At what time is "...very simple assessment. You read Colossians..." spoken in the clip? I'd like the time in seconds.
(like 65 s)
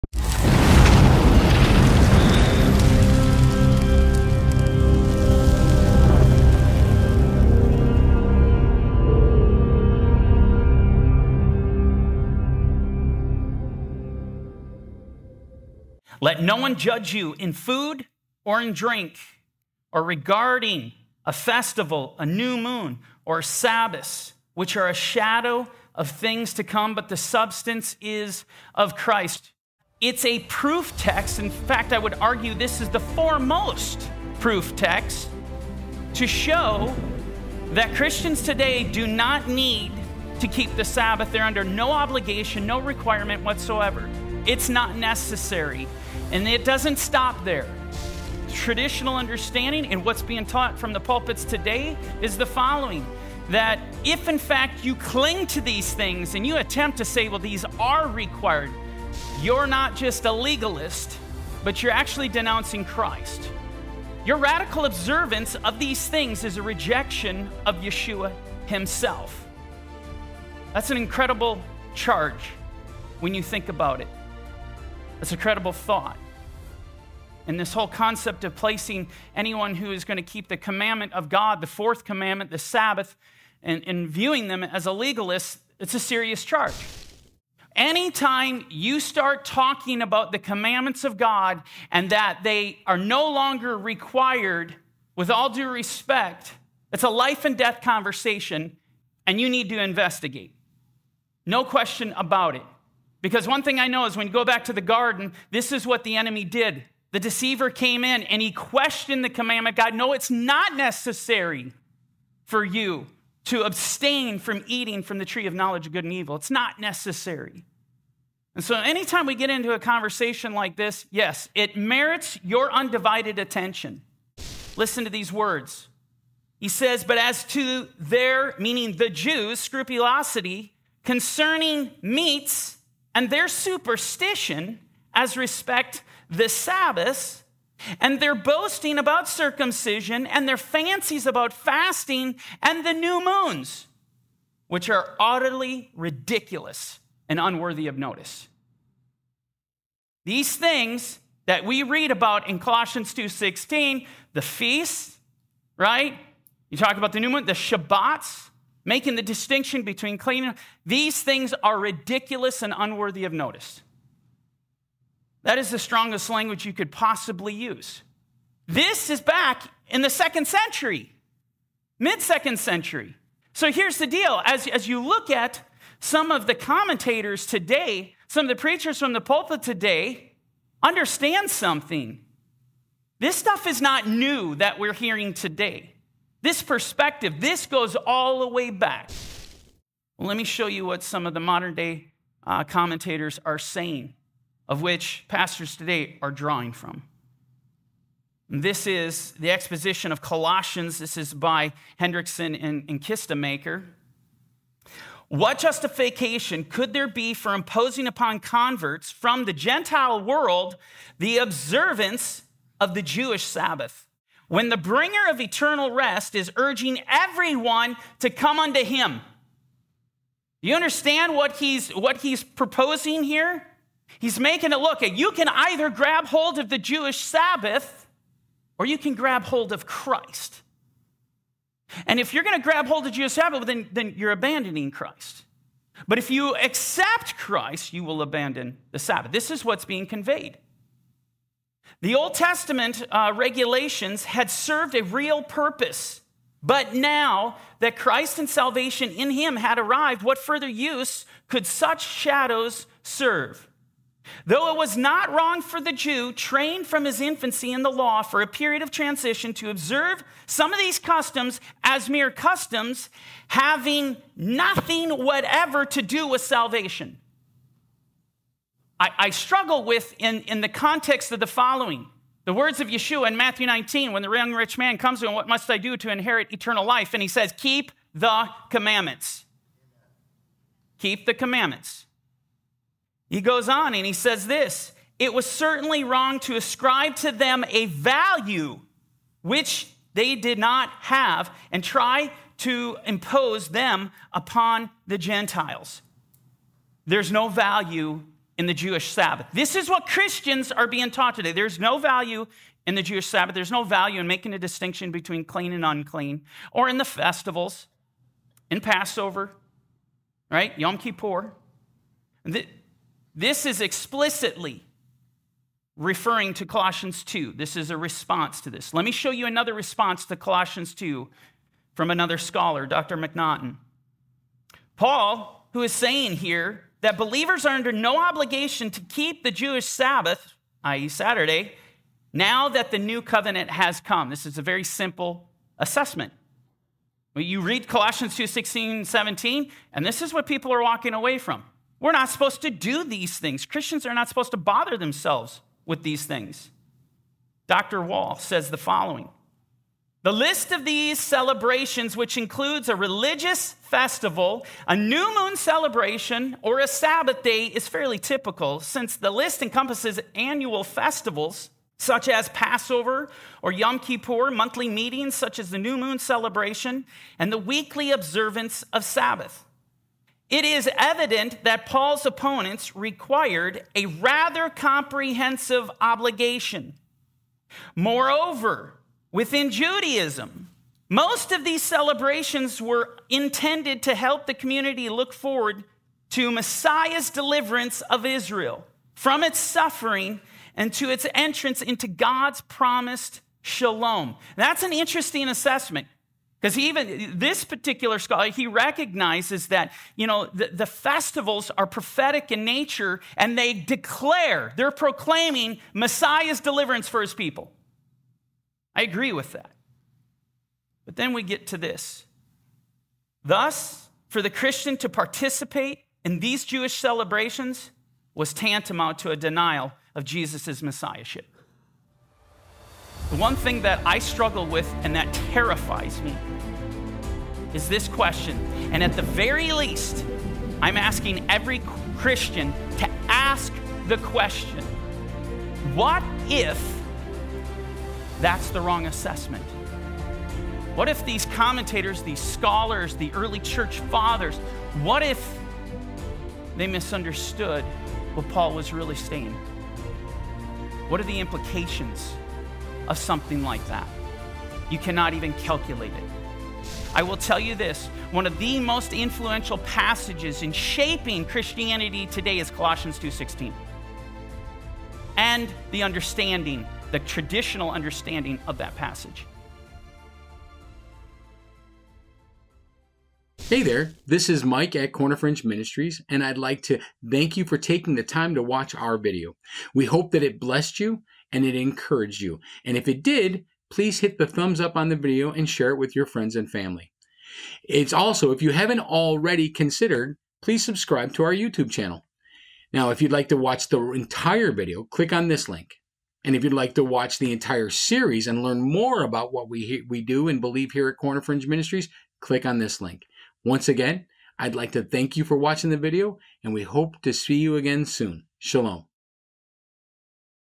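334 s.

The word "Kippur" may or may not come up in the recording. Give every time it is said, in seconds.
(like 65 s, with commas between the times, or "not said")
310 s, 363 s.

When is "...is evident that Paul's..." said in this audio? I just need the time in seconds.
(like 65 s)
370 s.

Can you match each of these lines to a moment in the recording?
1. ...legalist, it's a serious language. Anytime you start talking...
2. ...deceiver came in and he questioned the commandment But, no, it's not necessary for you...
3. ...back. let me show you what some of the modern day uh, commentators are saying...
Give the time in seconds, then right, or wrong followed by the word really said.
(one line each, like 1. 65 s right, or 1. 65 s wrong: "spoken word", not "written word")
1. 84 s wrong: "charge", not "language"
2. 107 s wrong: "God", not "But"
3. 188 s right.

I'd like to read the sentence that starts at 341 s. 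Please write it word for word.
We're not supposed to do these things.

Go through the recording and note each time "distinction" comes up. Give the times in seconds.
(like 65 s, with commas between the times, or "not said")
159 s, 304 s.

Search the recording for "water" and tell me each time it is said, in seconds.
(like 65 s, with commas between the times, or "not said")
not said.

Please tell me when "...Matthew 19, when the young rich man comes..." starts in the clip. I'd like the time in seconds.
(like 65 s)
273 s.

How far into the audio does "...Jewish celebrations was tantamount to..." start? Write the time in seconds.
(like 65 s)
416 s.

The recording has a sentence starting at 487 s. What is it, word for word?
It's also, if you haven't already considered, please subscribe to our YouTube channel.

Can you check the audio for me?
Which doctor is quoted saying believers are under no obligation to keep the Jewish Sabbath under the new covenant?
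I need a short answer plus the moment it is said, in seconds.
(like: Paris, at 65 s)
Dr. McNaughton, at 322 s.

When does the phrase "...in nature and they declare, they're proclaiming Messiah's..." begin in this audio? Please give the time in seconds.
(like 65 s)
402 s.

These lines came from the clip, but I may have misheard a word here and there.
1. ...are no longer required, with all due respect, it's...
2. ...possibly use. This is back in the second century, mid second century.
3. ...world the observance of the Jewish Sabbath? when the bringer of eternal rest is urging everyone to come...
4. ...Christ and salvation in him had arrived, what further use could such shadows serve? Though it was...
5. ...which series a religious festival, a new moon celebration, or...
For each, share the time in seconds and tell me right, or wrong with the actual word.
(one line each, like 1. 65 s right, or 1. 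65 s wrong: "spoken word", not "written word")
1. 92 s right
2. 166 s right
3. 210 s right
4. 247 s right
5. 352 s wrong: "includes", not "series".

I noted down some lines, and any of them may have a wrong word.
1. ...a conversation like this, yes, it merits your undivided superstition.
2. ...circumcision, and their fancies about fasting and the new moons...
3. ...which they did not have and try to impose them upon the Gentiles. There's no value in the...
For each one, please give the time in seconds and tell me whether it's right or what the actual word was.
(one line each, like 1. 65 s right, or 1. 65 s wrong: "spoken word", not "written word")
1. 119 s wrong: "attention", not "superstition"
2. 139 s right
3. 289 s right.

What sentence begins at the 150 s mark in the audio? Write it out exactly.
These things that we read about in Colossians 2:16, the feasts, right?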